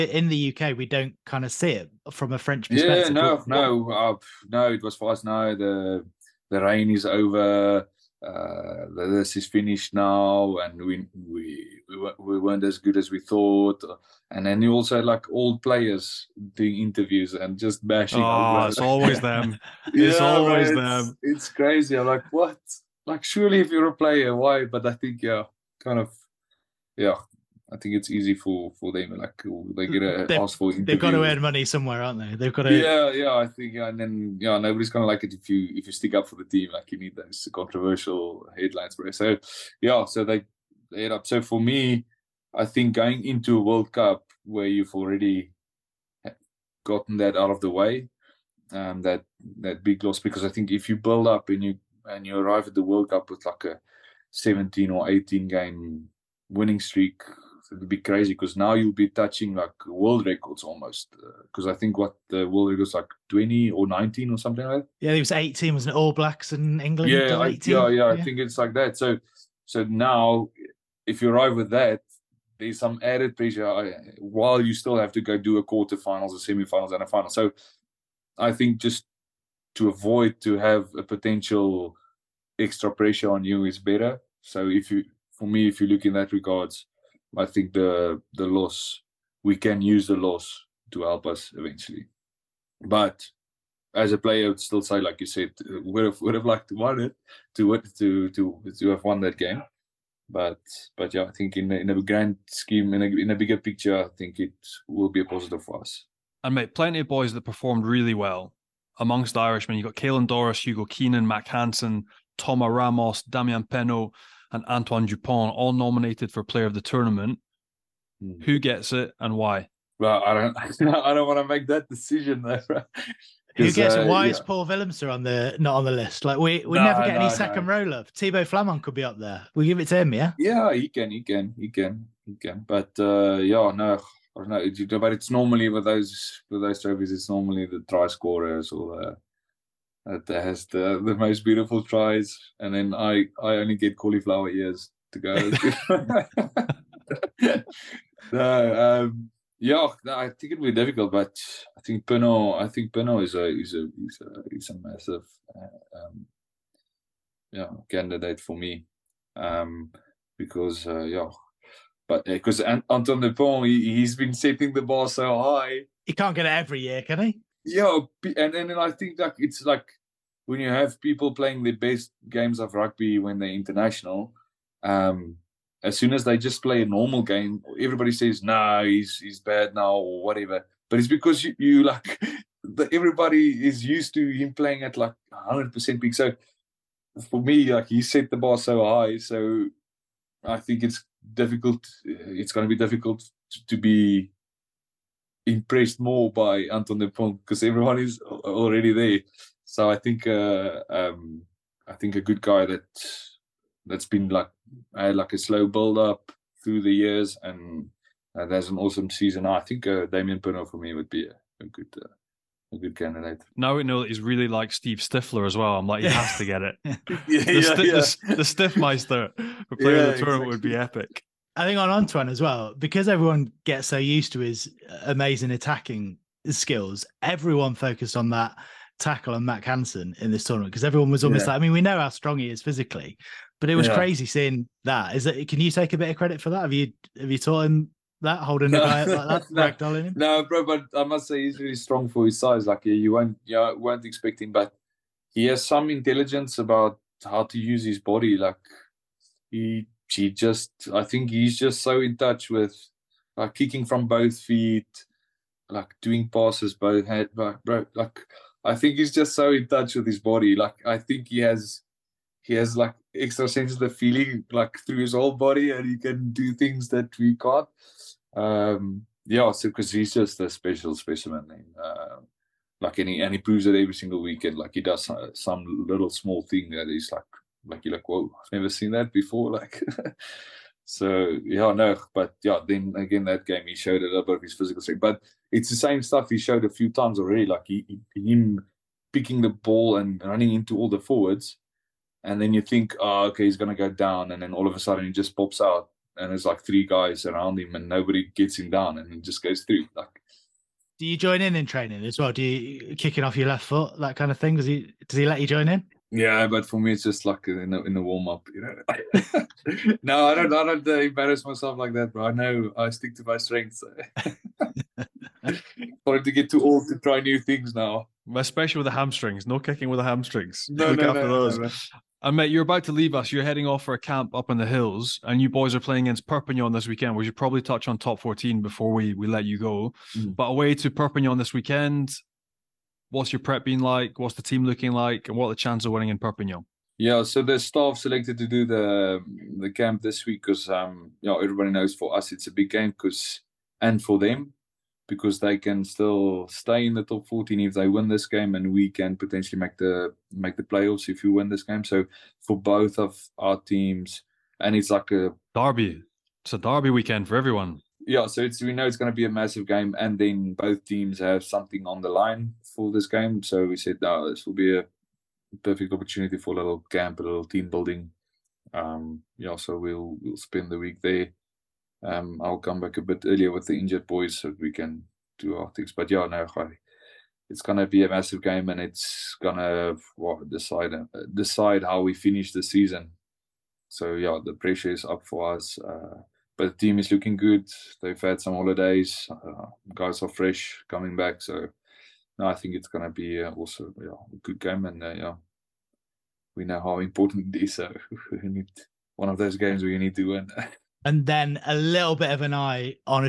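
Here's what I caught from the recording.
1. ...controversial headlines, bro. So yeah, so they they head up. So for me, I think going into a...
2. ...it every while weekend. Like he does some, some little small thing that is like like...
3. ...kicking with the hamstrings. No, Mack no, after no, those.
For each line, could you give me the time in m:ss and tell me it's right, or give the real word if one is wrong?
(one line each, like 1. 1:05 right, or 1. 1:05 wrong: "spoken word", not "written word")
1. 0:37 right
2. 4:33 wrong: "single", not "while"
3. 5:19 wrong: "Look", not "Mack".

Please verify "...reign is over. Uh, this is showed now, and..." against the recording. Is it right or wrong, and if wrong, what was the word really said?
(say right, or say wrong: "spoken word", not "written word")
wrong: "finished", not "showed".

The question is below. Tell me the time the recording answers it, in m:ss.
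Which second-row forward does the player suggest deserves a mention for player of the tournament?
2:08.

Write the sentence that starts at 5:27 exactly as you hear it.
We should probably touch on top 14 before we we let you go.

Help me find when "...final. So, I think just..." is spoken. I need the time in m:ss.
1:17.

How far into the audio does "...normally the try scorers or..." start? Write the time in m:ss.
2:17.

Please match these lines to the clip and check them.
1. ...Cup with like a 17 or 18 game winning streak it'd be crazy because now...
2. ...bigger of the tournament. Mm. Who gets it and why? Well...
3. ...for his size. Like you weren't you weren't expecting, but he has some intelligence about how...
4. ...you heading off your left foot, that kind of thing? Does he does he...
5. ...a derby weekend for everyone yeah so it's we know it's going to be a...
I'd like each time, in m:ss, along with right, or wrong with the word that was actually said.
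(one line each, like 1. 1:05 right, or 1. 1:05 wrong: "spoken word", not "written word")
1. 0:53 right
2. 1:56 wrong: "player", not "bigger"
3. 4:02 right
4. 5:02 wrong: "kicking", not "heading"
5. 5:56 right.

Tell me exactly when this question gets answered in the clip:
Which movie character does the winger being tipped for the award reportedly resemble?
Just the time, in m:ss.
3:34.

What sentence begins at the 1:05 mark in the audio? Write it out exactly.
Yeah, it was eighteen, was an All Blacks in England.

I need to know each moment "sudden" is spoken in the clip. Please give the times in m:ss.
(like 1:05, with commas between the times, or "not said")
4:54.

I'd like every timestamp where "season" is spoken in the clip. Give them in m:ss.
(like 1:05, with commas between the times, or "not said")
3:29, 6:22.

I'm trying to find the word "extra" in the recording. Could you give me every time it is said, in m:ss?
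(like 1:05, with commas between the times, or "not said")
1:22, 4:23.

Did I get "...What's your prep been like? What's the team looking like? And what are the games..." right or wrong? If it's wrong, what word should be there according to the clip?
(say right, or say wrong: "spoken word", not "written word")
wrong: "chances", not "games".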